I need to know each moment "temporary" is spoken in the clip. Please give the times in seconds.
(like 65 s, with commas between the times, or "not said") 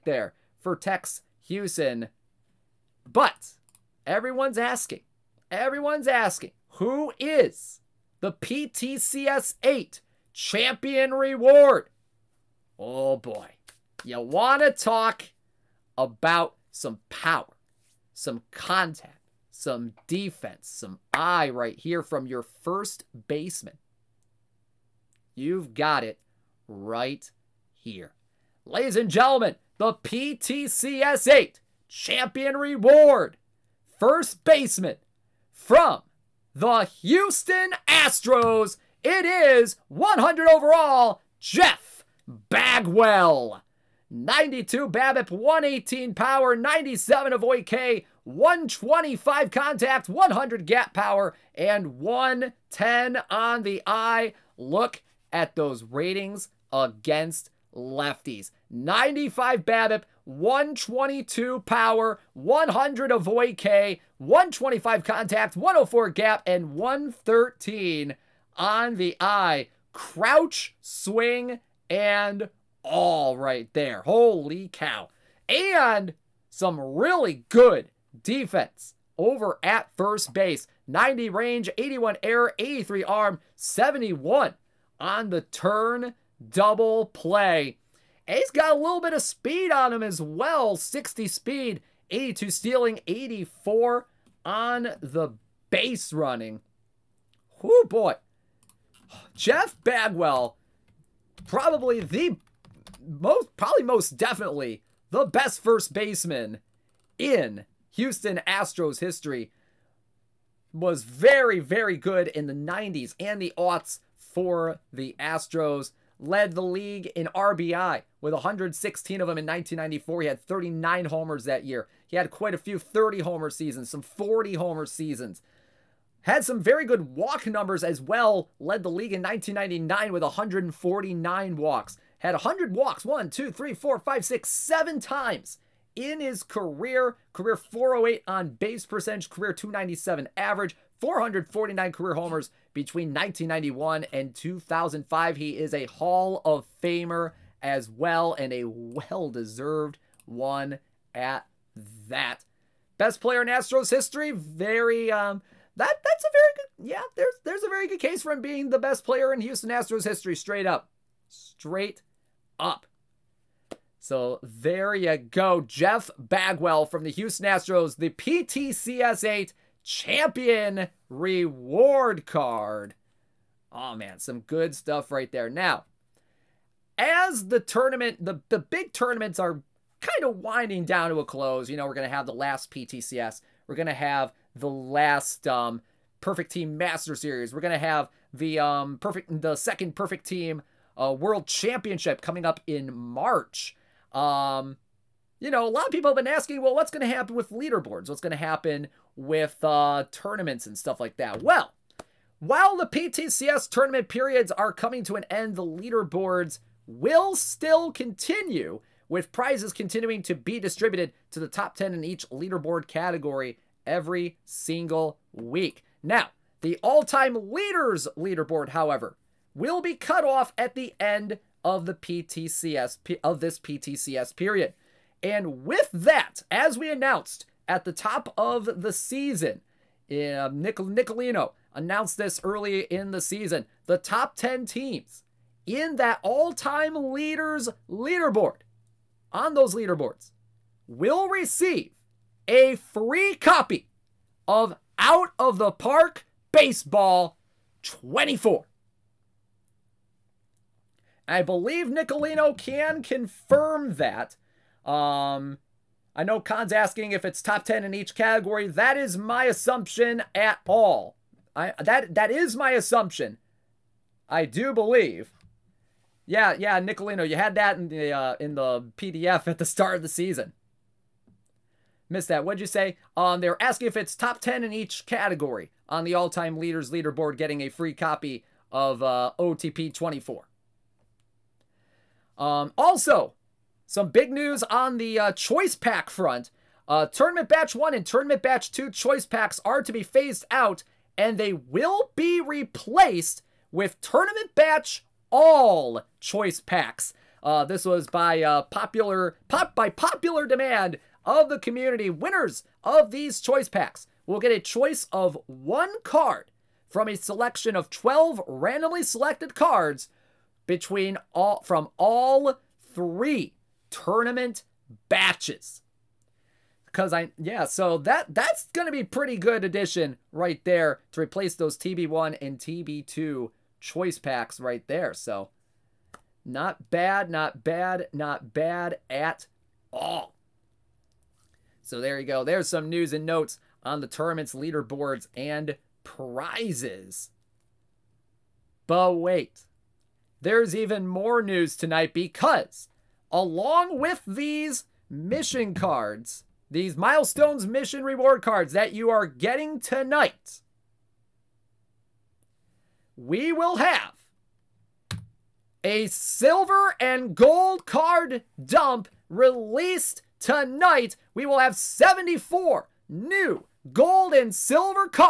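not said.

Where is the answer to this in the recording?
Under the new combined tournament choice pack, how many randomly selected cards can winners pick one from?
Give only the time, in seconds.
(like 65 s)
307 s.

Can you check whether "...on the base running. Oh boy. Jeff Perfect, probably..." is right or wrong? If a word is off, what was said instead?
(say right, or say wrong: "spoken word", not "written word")
wrong: "Bagwell", not "Perfect".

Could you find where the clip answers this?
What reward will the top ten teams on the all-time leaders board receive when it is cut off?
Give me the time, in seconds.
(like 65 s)
244 s.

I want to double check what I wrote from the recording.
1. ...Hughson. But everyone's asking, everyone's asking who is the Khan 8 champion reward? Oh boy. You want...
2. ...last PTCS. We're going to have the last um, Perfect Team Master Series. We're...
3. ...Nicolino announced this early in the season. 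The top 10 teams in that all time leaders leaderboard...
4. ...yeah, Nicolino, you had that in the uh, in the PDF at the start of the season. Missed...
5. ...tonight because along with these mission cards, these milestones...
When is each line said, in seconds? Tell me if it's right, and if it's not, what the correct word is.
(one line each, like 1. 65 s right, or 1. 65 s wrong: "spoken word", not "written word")
1. 1 s wrong: "PTCS", not "Khan"
2. 182 s right
3. 230 s right
4. 266 s right
5. 341 s right.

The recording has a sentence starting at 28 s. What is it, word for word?
Ladies and gentlemen, the PTCS 8 champion reward.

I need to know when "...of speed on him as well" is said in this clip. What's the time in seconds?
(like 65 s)
89 s.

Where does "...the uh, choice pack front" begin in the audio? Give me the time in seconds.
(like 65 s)
284 s.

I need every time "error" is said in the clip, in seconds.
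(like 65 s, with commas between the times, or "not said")
82 s.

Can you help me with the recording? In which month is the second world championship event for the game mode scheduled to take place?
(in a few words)
March.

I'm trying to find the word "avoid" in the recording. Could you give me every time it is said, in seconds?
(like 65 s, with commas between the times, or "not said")
47 s, 63 s.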